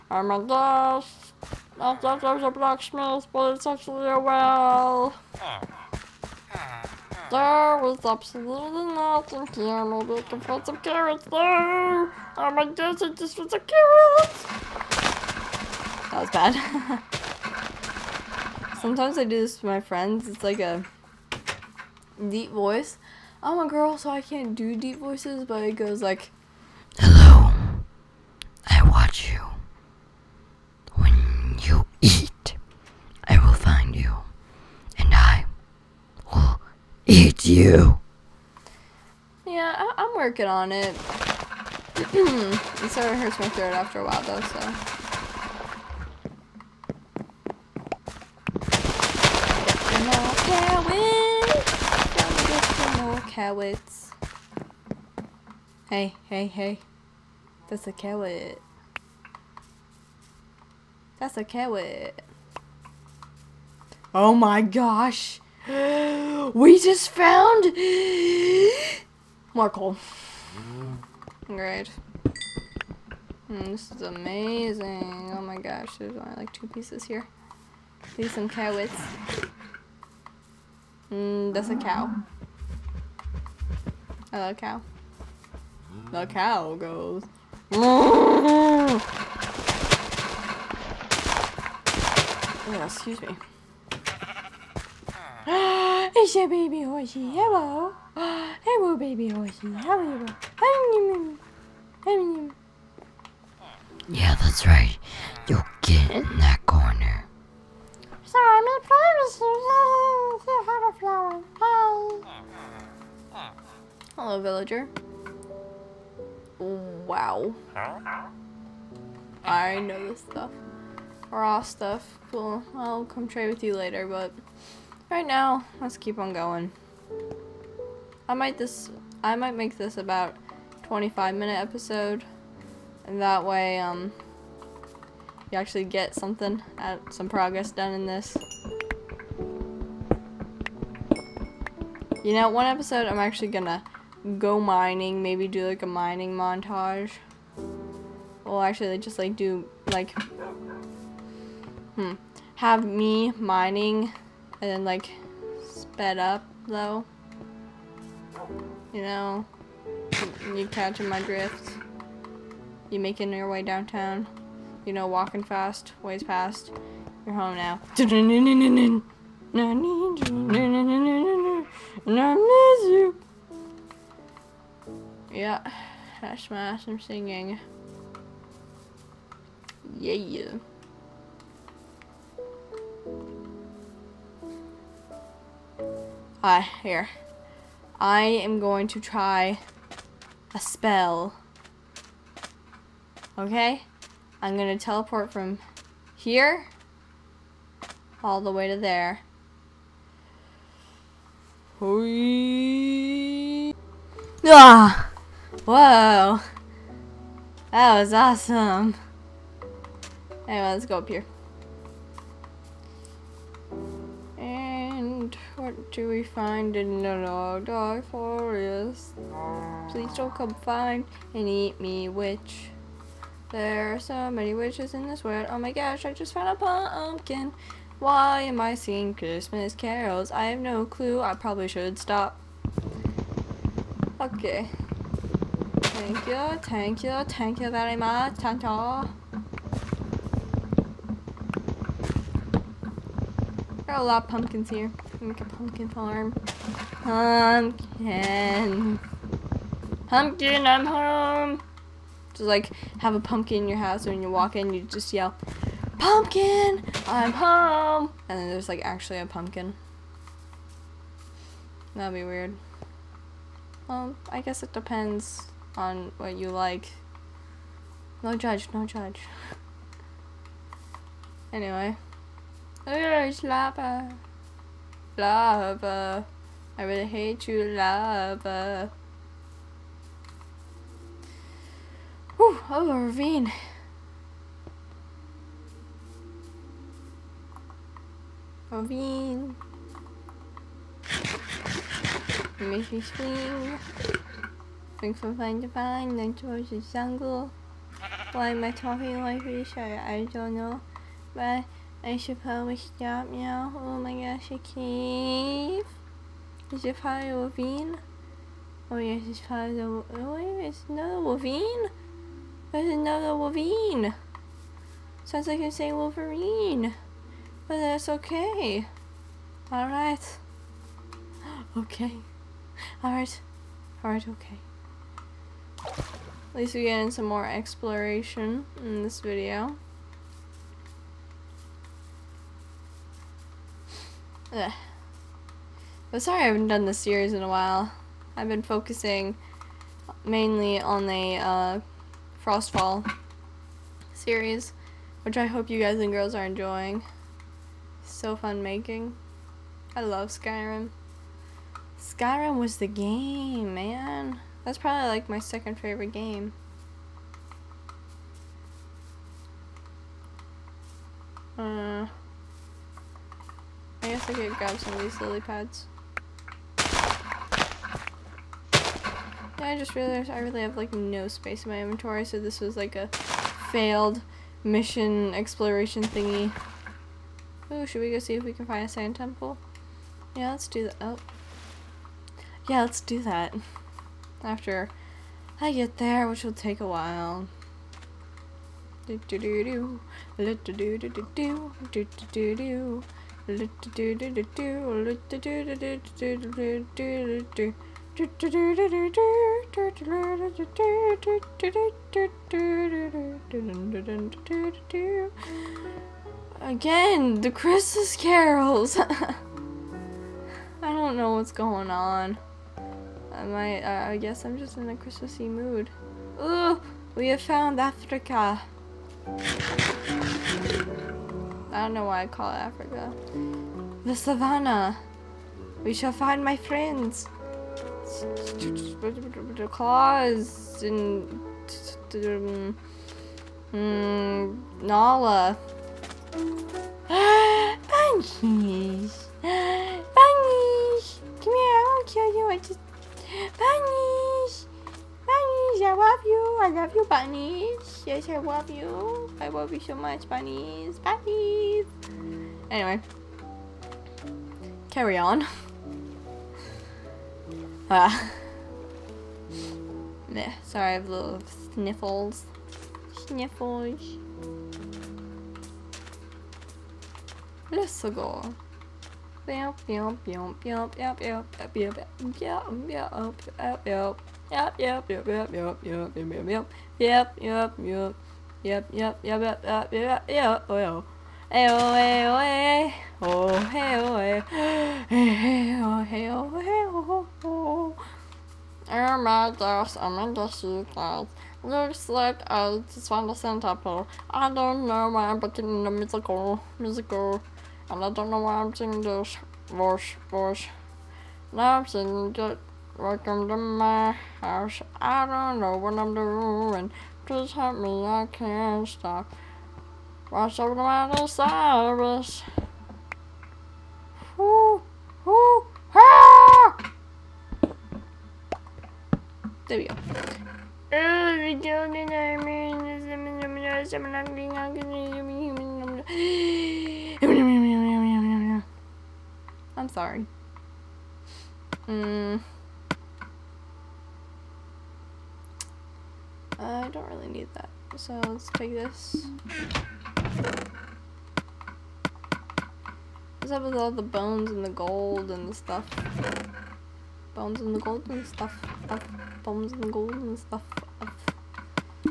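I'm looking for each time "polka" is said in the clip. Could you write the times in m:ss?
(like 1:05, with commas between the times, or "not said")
not said.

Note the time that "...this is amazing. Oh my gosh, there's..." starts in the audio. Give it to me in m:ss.
1:13.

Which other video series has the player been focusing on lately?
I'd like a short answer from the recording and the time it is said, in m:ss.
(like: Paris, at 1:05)
Frostfall, at 5:42.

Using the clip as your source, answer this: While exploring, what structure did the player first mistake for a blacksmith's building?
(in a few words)
A well.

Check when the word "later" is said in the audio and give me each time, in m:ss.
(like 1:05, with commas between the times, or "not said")
2:03.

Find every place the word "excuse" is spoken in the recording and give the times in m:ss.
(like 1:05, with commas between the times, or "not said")
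1:32.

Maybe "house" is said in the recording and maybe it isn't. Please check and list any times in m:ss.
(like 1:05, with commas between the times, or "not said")
4:13, 8:24.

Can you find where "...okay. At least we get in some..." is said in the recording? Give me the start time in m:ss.
5:24.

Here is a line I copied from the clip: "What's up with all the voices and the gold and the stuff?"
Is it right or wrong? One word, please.
wrong.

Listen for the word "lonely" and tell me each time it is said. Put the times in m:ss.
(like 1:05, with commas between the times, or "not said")
not said.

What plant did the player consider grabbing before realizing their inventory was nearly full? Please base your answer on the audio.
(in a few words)
Lily pads.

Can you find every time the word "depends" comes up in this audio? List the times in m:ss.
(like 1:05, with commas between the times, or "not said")
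4:24.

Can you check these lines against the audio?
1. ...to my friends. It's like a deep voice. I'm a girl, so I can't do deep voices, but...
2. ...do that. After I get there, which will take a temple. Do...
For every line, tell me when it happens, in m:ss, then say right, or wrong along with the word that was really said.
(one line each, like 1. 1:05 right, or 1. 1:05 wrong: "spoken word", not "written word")
1. 0:19 right
2. 6:22 wrong: "while", not "temple".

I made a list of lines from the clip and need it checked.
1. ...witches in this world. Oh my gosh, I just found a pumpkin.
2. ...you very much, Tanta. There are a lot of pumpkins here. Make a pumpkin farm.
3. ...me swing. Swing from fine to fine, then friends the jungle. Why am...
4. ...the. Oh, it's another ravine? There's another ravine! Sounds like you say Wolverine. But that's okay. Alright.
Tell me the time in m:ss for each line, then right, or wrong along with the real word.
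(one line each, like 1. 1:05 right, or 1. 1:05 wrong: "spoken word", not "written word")
1. 3:44 right
2. 3:57 right
3. 4:52 wrong: "towards", not "friends"
4. 5:09 right.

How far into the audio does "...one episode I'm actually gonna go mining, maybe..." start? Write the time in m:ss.
2:22.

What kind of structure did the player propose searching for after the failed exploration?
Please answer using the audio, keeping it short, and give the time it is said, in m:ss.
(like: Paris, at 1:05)
Sand temple, at 6:18.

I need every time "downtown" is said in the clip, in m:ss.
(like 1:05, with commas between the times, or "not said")
2:43.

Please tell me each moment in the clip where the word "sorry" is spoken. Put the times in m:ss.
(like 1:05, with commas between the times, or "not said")
5:36, 7:40, 8:49.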